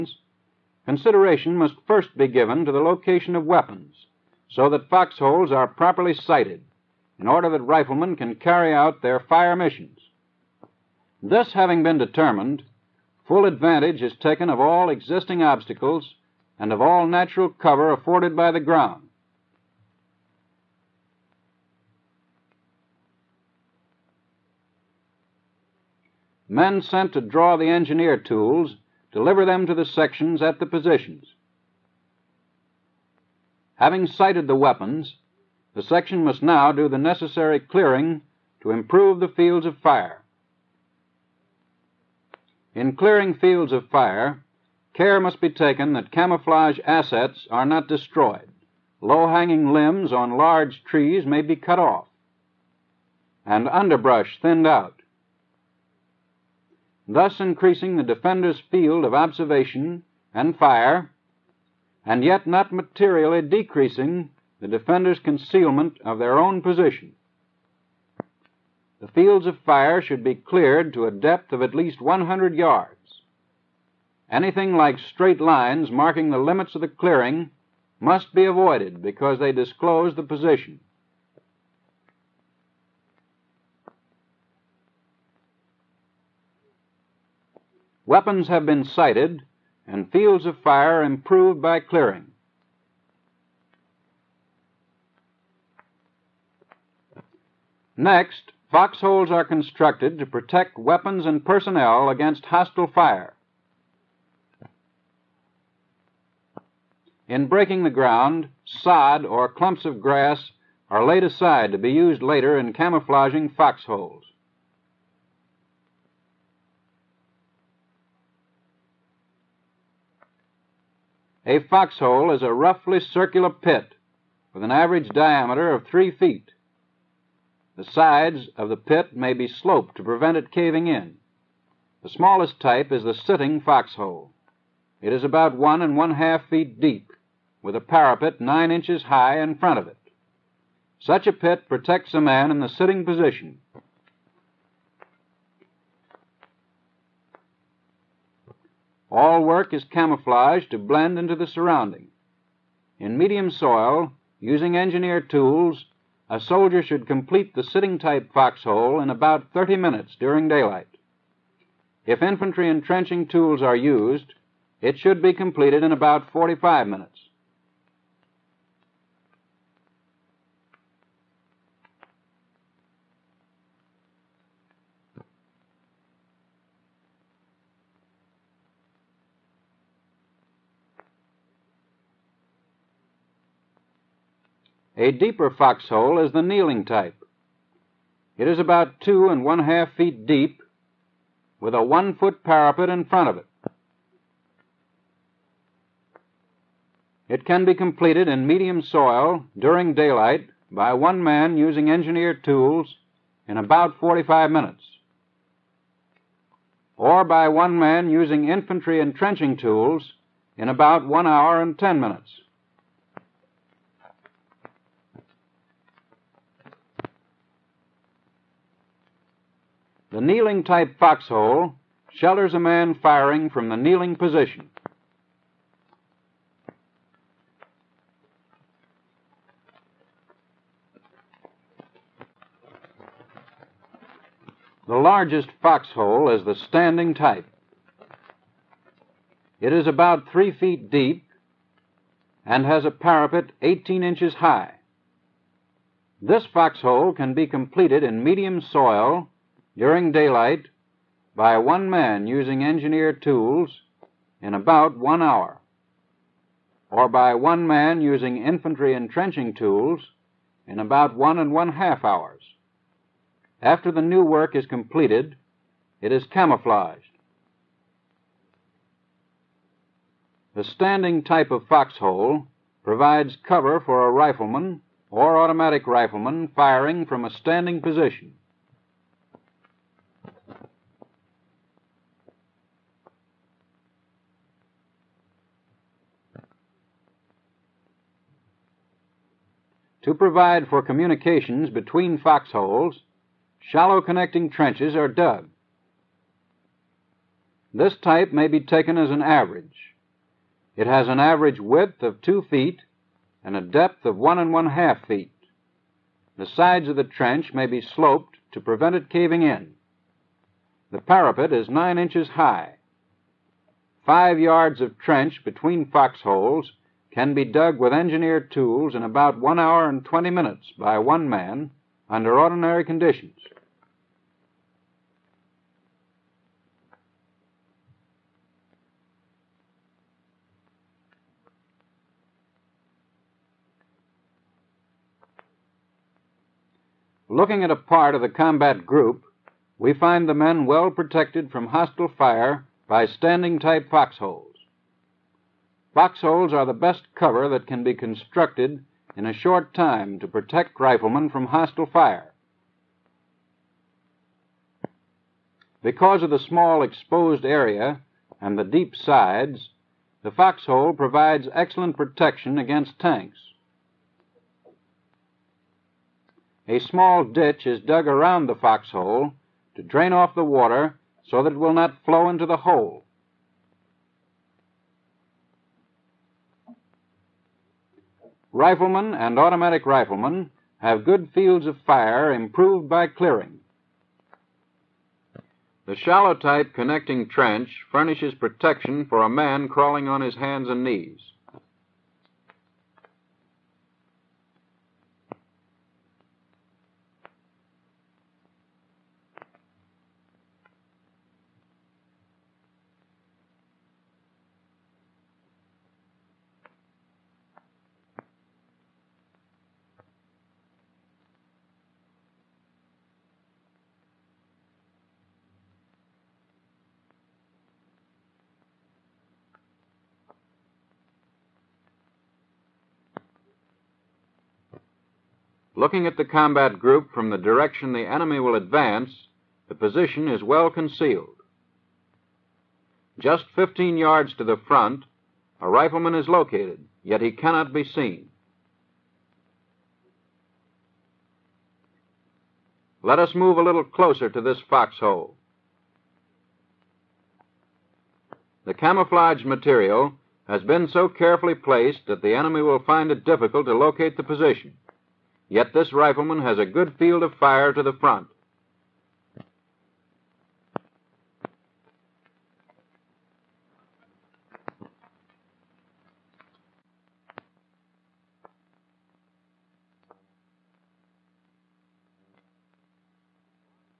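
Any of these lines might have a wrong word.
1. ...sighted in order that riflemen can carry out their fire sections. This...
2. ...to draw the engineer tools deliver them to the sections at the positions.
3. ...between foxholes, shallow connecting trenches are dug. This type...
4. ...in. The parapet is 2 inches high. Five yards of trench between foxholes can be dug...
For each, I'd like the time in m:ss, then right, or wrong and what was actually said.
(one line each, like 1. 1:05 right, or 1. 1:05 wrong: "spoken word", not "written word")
1. 0:06 wrong: "missions", not "sections"
2. 0:27 right
3. 4:51 right
4. 5:09 wrong: "9", not "2".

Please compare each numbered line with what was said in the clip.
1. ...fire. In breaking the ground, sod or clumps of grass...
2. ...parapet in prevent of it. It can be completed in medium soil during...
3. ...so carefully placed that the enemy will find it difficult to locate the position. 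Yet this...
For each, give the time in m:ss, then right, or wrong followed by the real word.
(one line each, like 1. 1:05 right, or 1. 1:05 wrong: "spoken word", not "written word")
1. 1:42 right
2. 3:12 wrong: "front", not "prevent"
3. 7:30 right.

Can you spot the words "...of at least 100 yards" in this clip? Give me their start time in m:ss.
1:11.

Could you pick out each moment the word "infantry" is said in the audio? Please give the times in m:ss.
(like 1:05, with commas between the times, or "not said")
2:42, 3:28, 4:18.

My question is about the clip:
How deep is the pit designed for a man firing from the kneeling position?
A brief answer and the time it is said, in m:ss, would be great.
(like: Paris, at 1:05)
2.5 feet, at 3:08.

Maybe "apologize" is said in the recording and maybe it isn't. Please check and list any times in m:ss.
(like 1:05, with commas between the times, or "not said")
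not said.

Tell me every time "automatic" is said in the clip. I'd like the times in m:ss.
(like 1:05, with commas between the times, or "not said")
4:35, 6:19.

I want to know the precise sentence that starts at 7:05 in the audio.
Looking at the combat group from the direction the enemy will advance, the position is well concealed.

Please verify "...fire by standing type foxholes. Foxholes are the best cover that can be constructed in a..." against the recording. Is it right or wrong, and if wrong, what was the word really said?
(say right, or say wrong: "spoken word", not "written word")
right.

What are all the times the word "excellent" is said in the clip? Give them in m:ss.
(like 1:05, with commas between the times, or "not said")
6:01.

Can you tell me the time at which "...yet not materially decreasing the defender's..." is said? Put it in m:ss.
1:02.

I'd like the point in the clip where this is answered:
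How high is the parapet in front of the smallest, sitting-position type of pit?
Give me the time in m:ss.
2:18.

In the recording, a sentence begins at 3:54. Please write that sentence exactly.
The largest foxhole is the standing type.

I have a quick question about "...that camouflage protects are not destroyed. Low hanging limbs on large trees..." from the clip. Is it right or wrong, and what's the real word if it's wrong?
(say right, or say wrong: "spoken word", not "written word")
wrong: "assets", not "protects".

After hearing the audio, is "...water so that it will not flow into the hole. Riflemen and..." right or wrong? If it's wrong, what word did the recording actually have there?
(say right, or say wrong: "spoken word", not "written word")
right.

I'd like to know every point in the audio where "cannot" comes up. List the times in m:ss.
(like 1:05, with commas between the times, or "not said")
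7:17.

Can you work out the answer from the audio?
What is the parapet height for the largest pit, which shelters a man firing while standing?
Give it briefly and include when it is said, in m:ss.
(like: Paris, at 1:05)
18 inches, at 4:03.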